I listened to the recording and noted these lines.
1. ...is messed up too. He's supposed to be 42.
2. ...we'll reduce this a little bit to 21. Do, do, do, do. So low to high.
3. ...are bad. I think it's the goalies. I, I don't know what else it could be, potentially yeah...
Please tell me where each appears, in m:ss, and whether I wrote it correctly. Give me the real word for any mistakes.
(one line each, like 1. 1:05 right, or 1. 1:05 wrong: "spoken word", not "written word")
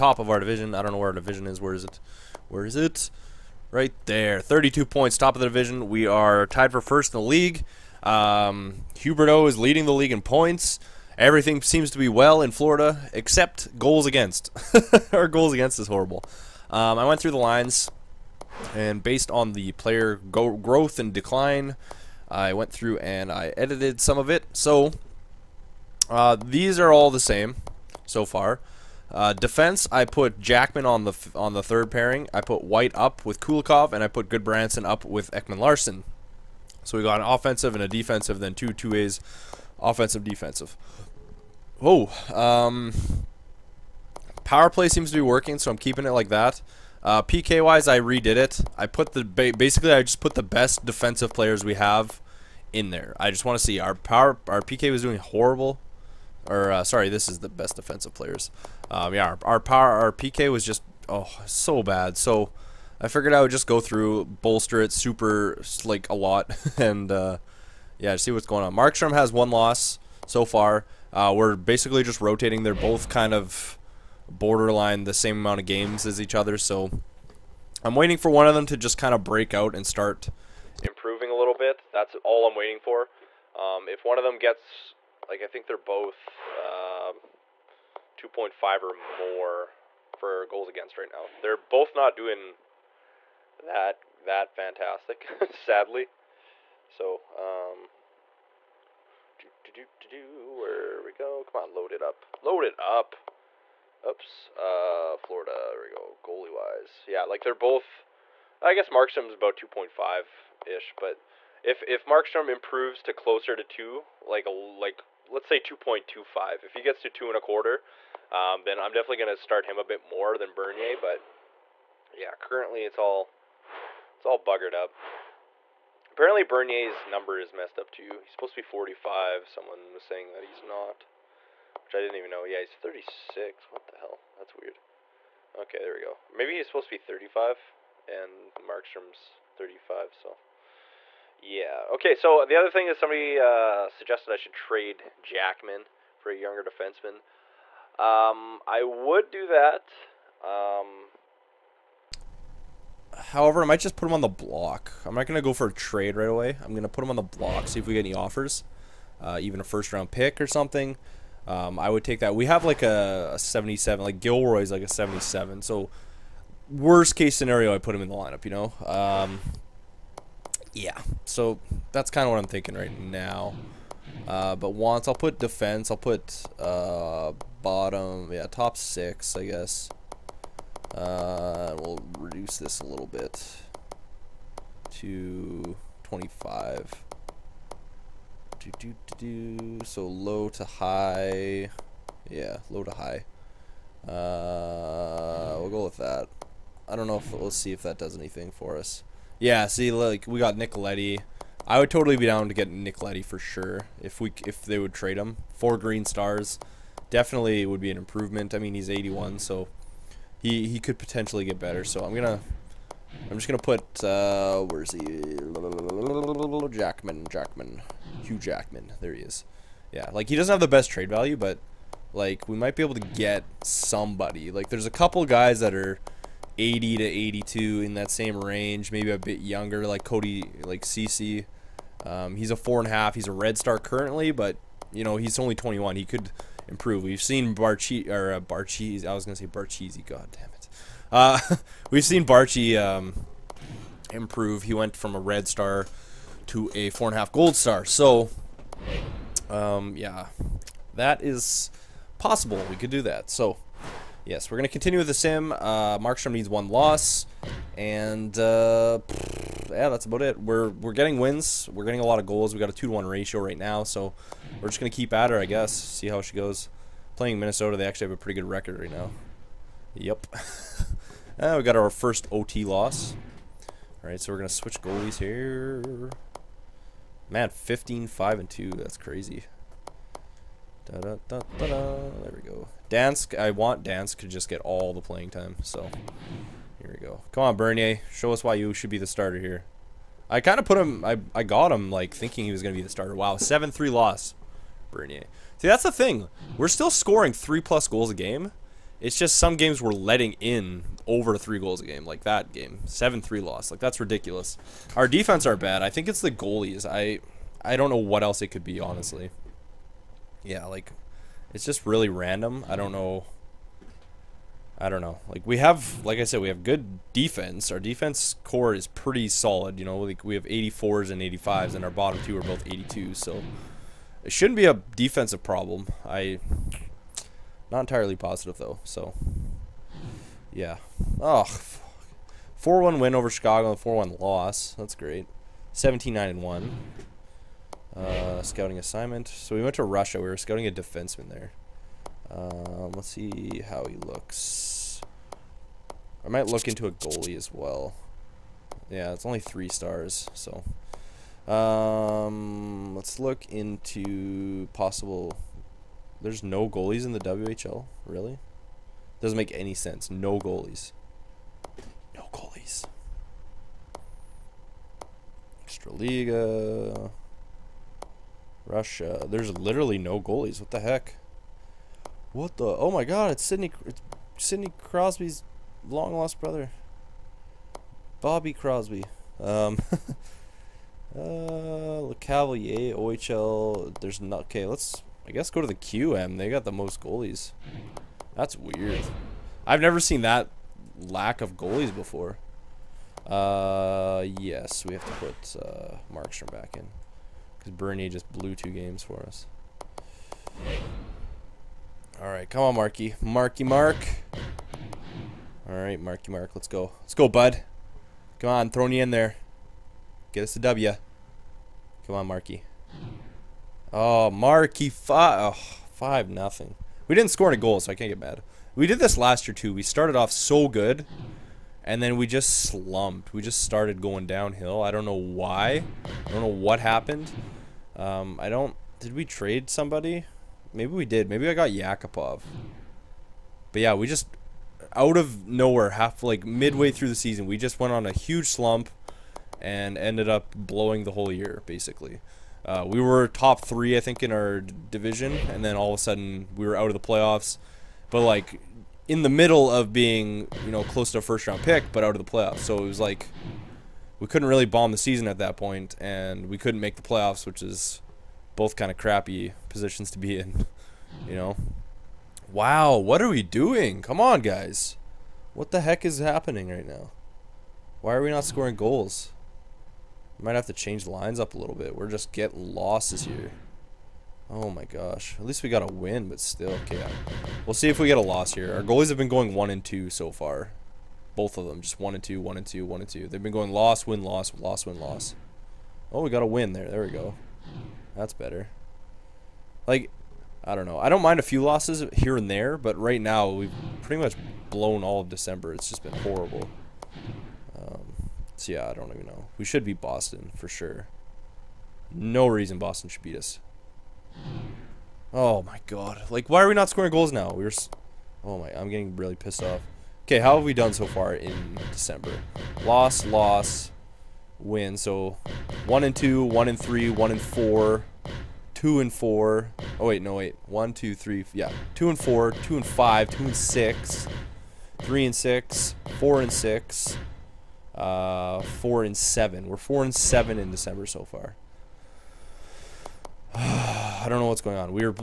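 1. 2:07 wrong: "45", not "42"
2. 3:01 wrong: "25", not "21"
3. 5:05 wrong: "honestly", not "potentially".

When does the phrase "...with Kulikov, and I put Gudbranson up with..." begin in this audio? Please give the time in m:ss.
0:33.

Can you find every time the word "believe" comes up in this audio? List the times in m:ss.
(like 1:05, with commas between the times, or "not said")
not said.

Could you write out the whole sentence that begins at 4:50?
I kind of put him, I, I got him, like, thinking he was going to be the starter.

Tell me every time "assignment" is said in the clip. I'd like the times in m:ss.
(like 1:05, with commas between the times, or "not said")
5:38.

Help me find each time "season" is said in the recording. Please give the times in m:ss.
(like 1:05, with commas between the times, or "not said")
7:17, 7:34.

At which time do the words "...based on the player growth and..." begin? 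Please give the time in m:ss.
0:19.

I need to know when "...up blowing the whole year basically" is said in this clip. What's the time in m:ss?
7:20.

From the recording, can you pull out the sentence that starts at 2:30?
Um, however, I might just put him on the block.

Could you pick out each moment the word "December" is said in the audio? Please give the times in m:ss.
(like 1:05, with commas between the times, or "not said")
8:15, 8:31, 8:50.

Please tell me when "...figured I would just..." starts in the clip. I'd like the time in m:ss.
1:03.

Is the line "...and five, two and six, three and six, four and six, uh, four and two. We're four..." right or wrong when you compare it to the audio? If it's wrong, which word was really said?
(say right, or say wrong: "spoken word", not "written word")
wrong: "seven", not "two".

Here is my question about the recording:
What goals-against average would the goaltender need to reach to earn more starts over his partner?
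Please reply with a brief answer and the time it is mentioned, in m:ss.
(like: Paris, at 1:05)
2.25, at 1:55.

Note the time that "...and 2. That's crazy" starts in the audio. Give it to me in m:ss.
4:38.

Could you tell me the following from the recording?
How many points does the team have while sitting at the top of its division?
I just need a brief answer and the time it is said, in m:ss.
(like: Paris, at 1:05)
32, at 0:04.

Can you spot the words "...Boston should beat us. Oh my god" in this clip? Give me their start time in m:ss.
8:22.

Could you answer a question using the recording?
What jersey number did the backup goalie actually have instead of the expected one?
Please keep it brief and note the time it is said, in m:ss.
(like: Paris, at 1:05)
36, at 2:12.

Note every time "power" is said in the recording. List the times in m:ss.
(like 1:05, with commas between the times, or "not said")
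0:44, 0:53, 0:59.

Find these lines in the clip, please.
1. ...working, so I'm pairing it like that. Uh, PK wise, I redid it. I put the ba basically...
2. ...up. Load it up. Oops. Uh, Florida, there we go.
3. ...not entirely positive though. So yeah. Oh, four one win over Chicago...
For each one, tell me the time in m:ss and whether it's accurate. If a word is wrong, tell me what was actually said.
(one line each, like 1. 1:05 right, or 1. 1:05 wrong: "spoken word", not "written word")
1. 0:45 wrong: "keeping", not "pairing"
2. 1:42 right
3. 5:27 right.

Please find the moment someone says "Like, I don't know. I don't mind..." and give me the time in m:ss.
8:09.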